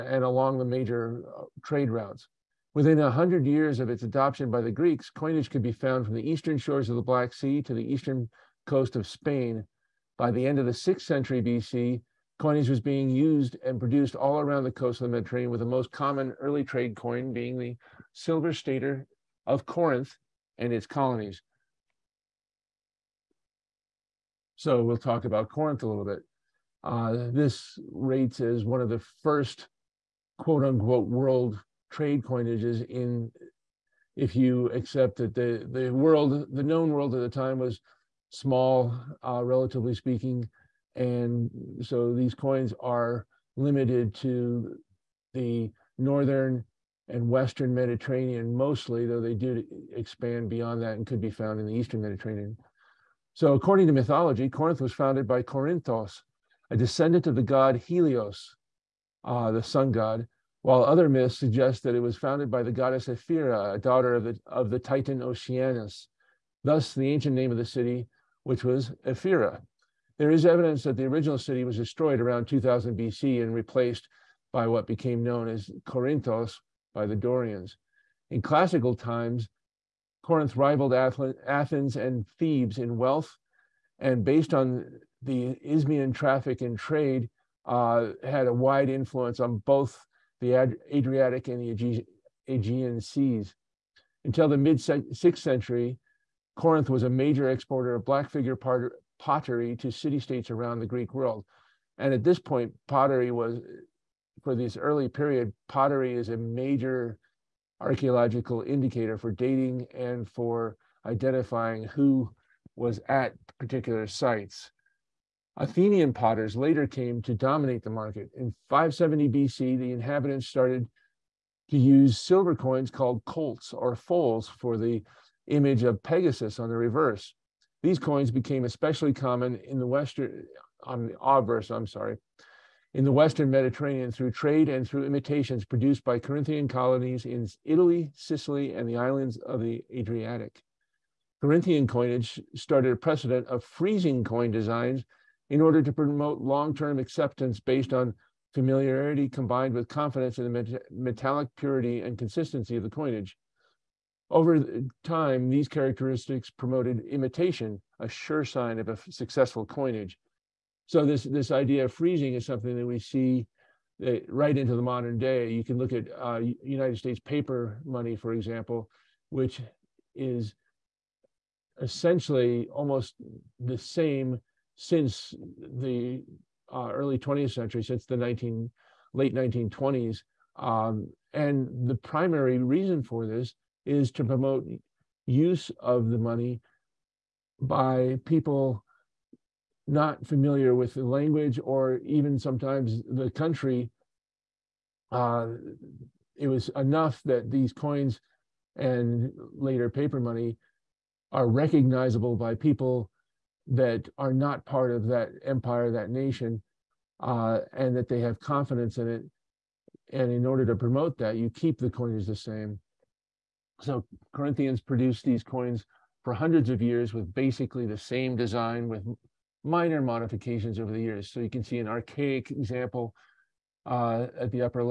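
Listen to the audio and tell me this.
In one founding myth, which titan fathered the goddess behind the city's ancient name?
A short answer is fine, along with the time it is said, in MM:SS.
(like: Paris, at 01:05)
Oceanus, at 01:05.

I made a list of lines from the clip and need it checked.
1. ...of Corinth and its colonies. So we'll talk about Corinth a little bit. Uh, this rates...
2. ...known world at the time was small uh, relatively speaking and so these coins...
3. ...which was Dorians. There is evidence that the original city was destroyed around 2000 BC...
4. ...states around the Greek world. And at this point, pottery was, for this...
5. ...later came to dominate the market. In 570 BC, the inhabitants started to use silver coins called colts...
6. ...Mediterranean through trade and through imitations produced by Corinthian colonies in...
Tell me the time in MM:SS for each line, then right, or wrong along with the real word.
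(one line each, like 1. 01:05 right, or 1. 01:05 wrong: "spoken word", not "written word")
1. 00:19 right
2. 00:36 right
3. 01:08 wrong: "Ephyra", not "Dorians"
4. 01:40 right
5. 01:56 right
6. 02:13 right.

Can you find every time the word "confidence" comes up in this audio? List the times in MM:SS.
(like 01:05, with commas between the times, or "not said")
02:29, 03:28.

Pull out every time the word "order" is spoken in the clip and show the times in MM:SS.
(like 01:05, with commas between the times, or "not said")
02:25, 03:30.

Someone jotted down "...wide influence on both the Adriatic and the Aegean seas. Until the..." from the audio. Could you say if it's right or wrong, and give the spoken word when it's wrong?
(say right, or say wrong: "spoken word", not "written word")
right.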